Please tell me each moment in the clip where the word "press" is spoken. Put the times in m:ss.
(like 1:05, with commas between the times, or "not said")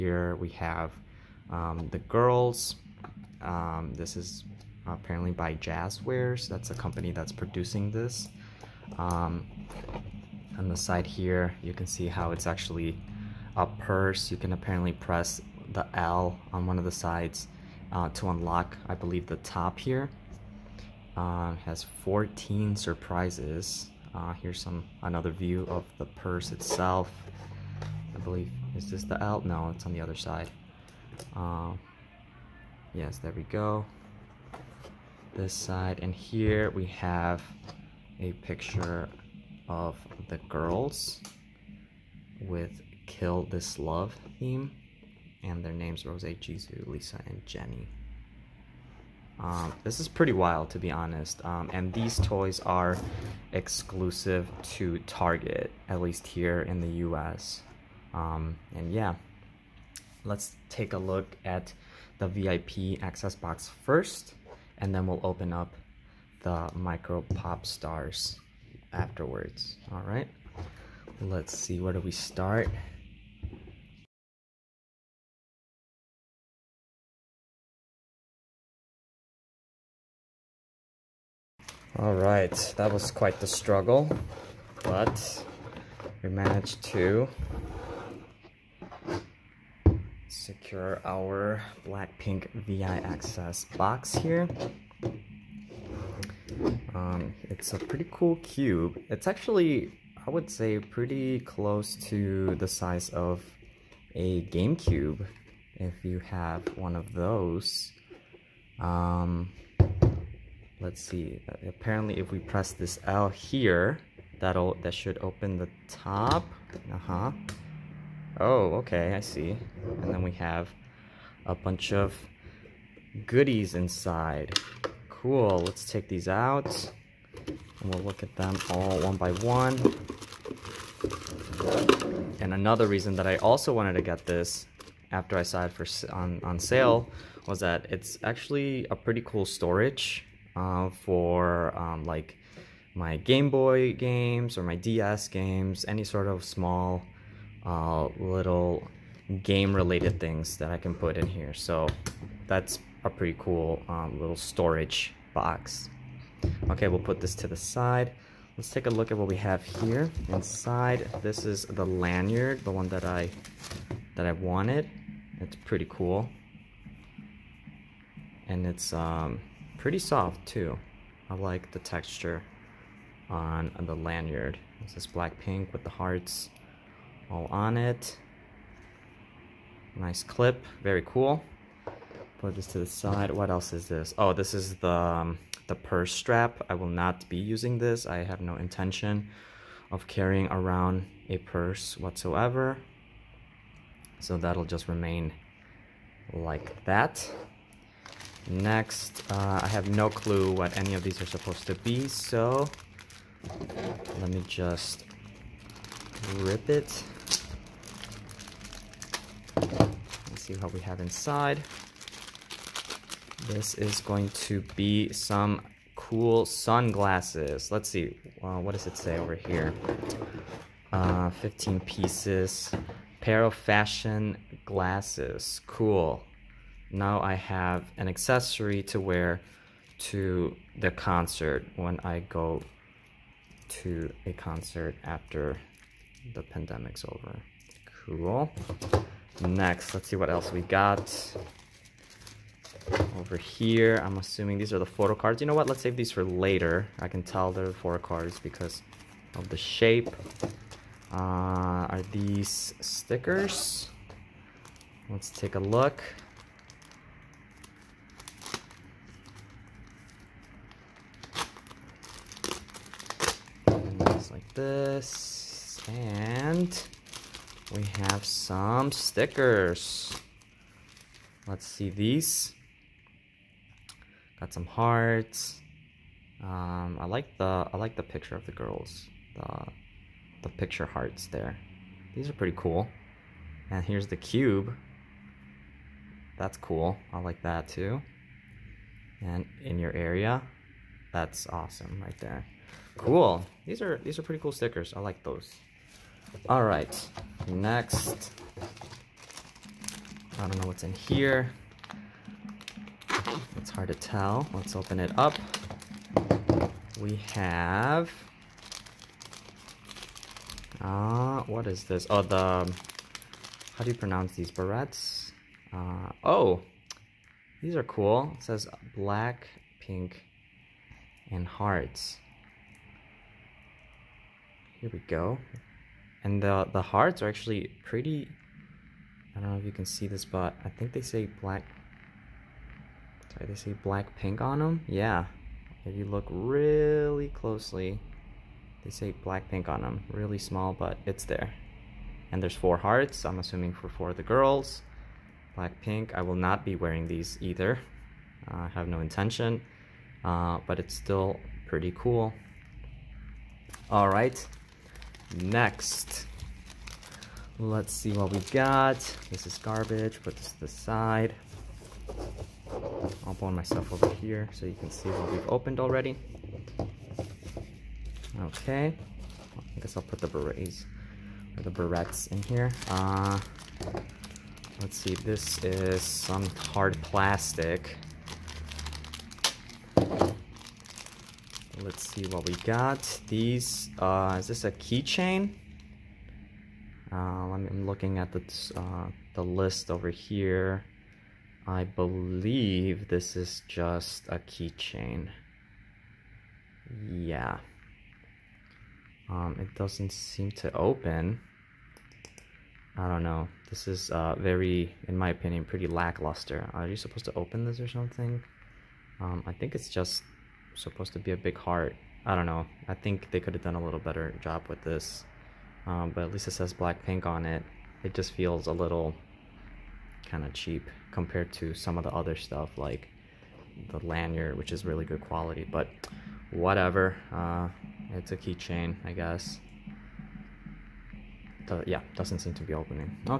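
0:14, 1:52.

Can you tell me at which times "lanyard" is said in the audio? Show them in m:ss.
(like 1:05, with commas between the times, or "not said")
2:41, 2:53, 7:04.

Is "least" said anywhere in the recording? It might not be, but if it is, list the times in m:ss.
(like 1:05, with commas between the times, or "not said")
0:56, 6:56.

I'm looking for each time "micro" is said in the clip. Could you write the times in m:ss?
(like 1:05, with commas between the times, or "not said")
1:06.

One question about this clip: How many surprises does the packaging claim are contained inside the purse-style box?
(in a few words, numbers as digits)
14.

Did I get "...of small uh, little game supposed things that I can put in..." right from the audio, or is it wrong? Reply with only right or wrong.
wrong.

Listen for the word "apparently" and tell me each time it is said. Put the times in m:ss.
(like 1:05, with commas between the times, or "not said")
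0:04, 0:14, 1:51.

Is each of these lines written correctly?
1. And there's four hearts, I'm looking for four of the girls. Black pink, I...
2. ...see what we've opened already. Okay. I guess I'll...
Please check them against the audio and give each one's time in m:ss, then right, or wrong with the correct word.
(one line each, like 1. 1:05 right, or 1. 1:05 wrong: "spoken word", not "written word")
1. 5:42 wrong: "assuming", not "looking"
2. 6:04 right.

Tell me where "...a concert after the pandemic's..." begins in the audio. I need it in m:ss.
3:54.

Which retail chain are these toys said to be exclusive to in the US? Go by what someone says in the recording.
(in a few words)
Target.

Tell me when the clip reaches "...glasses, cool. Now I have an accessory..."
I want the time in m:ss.
3:44.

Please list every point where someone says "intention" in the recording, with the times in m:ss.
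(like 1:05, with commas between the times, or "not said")
3:08, 5:48.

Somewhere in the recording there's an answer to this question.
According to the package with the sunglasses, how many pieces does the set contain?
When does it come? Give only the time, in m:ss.
3:41.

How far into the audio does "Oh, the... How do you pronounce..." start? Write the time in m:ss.
5:12.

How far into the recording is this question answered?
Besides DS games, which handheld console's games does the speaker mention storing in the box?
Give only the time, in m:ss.
2:23.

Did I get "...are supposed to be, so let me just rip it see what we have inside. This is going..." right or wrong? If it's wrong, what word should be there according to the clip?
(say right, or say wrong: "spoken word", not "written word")
right.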